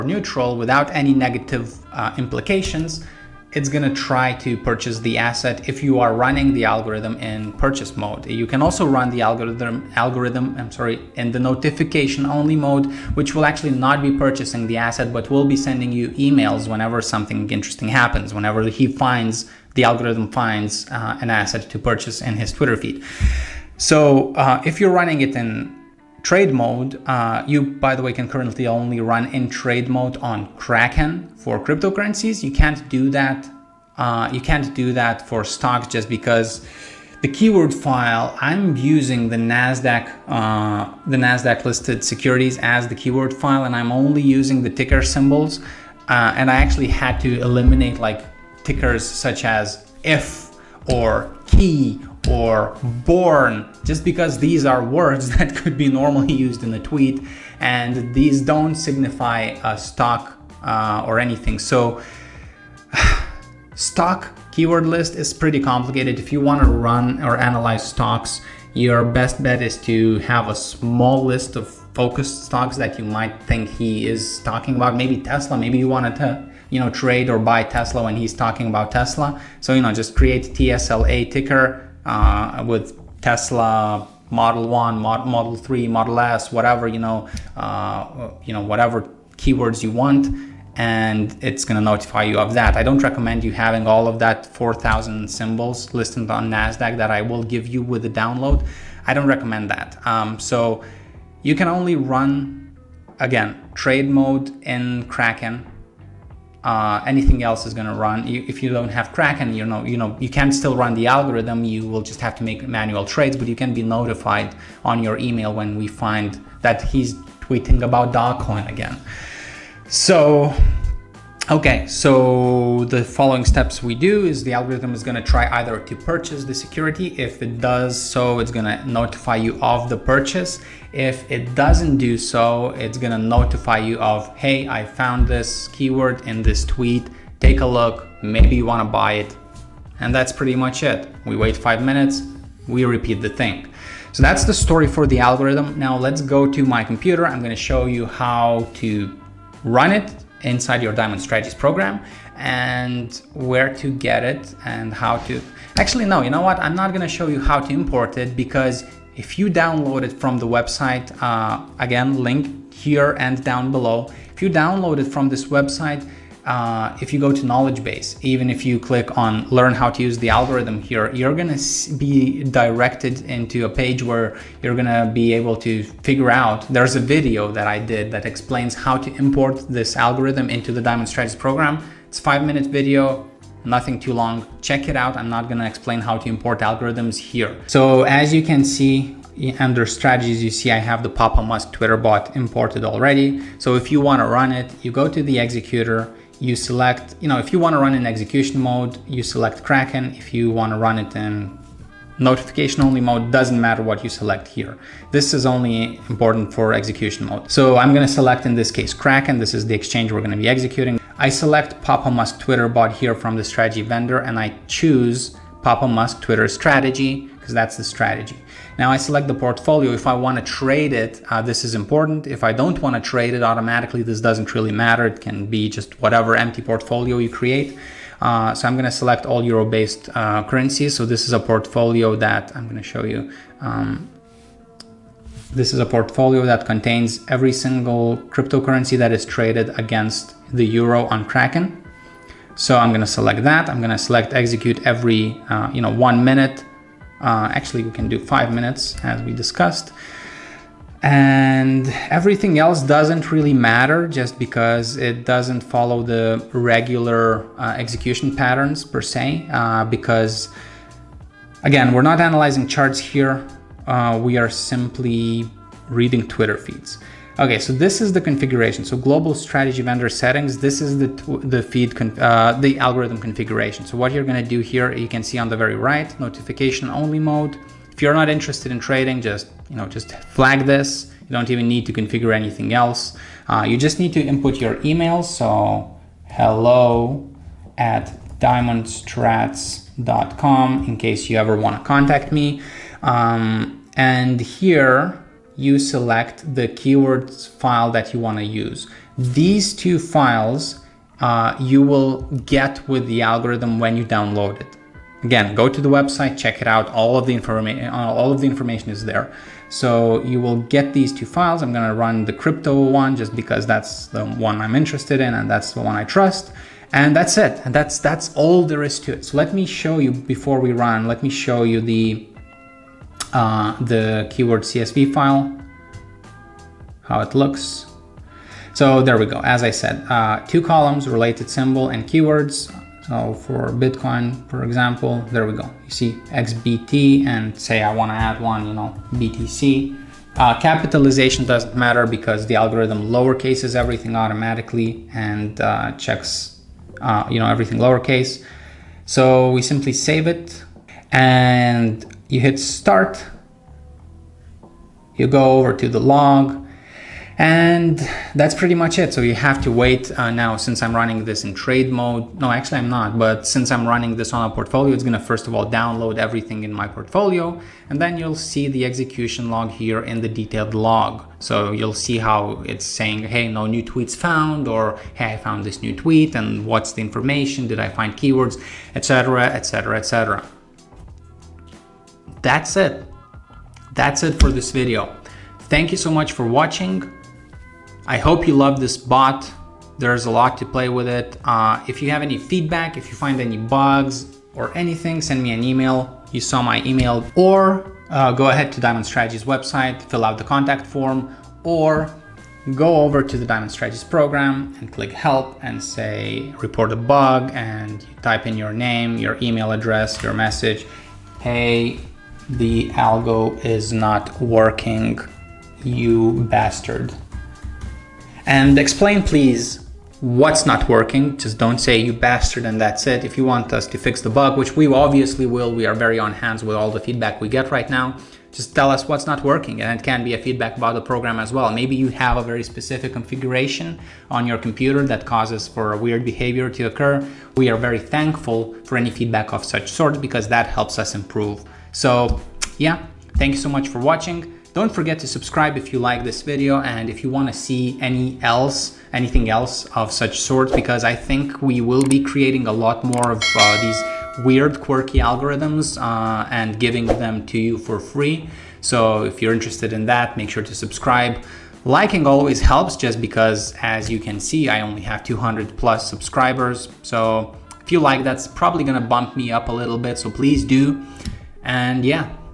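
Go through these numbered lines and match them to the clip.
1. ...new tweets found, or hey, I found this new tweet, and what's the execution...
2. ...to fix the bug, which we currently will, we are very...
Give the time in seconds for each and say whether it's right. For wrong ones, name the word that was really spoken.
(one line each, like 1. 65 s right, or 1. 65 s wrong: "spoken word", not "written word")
1. 373 s wrong: "information", not "execution"
2. 423 s wrong: "obviously", not "currently".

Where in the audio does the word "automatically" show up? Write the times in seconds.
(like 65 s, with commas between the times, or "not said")
223 s, 344 s.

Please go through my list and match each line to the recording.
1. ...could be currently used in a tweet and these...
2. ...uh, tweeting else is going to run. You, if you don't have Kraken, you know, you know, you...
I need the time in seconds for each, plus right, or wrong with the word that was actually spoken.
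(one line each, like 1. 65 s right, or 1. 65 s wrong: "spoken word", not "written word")
1. 55 s wrong: "normally", not "currently"
2. 106 s wrong: "anything", not "tweeting".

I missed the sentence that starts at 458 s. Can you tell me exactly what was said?
So if you're interested in that, make sure to subscribe.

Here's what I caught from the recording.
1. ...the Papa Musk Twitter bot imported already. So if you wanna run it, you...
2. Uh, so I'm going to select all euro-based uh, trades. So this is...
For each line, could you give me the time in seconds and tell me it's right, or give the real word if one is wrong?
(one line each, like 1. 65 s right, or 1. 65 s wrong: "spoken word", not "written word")
1. 191 s right
2. 228 s wrong: "currencies", not "trades".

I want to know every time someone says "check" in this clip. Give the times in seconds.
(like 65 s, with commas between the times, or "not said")
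184 s, 306 s, 345 s.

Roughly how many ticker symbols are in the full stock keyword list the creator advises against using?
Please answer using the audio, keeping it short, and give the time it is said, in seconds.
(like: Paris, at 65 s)
4,000, at 94 s.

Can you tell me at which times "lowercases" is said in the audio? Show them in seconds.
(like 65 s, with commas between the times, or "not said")
343 s, 347 s.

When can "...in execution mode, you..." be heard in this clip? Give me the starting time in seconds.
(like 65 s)
197 s.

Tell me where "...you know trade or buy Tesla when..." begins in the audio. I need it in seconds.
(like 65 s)
76 s.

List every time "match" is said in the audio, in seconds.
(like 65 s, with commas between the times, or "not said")
not said.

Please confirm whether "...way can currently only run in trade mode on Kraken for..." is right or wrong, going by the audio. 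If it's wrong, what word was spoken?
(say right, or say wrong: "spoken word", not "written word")
right.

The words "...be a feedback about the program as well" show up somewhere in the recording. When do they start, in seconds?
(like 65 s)
430 s.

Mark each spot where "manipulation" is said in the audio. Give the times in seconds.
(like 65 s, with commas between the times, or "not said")
not said.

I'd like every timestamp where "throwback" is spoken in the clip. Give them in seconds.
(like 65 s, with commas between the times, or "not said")
not said.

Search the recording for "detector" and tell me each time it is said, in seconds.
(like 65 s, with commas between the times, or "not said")
not said.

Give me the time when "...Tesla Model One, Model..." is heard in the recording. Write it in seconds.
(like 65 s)
83 s.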